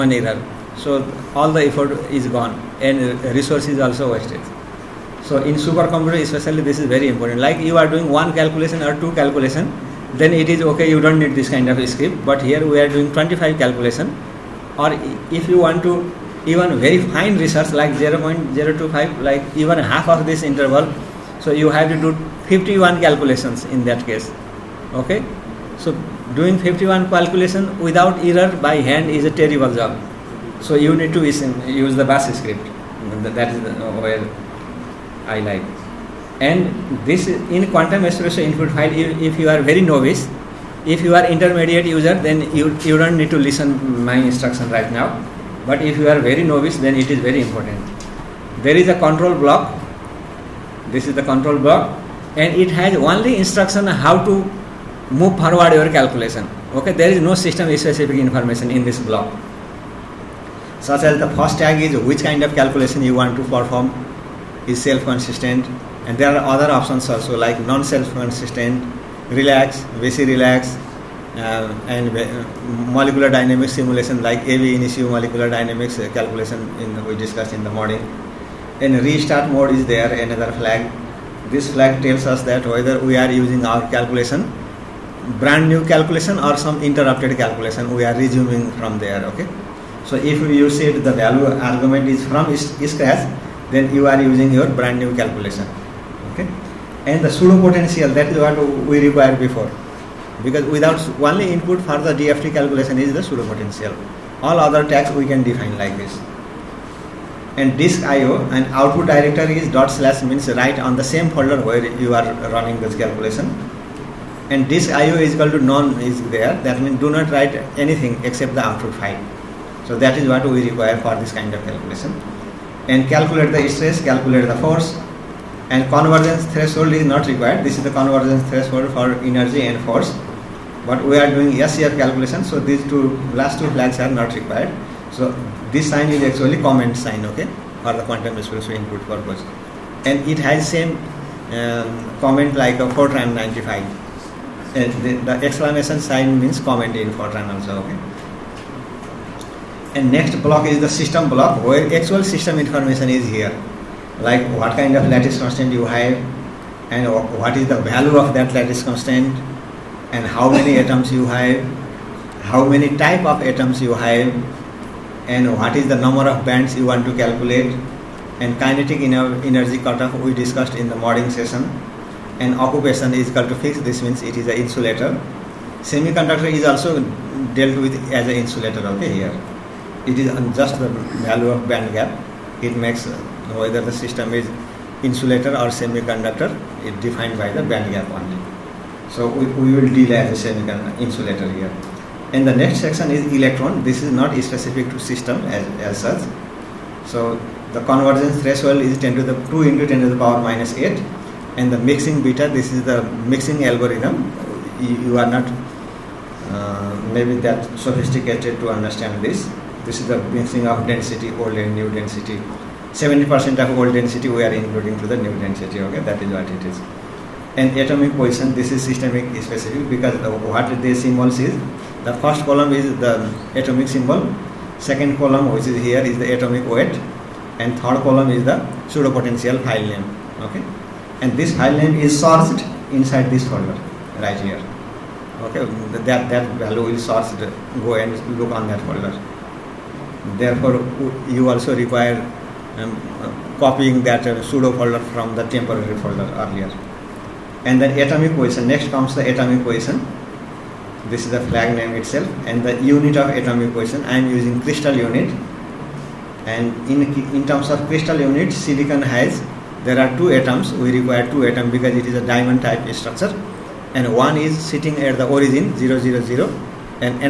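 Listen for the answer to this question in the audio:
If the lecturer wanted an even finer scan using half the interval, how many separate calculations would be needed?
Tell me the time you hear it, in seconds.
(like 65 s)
22 s.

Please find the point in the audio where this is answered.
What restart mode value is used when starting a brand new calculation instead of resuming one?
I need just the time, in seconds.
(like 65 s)
92 s.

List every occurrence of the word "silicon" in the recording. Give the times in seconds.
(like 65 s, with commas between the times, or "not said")
258 s.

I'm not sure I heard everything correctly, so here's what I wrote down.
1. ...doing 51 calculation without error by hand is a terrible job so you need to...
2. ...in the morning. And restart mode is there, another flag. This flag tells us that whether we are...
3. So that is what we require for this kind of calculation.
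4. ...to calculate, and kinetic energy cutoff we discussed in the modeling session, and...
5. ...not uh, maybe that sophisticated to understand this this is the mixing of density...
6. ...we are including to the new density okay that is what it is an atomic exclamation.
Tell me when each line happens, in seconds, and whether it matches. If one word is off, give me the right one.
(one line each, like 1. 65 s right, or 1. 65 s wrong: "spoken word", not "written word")
1. 26 s right
2. 77 s right
3. 119 s right
4. 167 s right
5. 205 s right
6. 214 s wrong: "position", not "exclamation".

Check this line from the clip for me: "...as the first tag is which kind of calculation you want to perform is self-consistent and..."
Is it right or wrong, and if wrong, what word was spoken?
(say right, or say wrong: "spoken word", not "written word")
right.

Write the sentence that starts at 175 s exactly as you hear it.
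Semiconductor is also dealt with as an insulator, okay, here.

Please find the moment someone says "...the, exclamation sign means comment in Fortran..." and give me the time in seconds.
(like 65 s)
145 s.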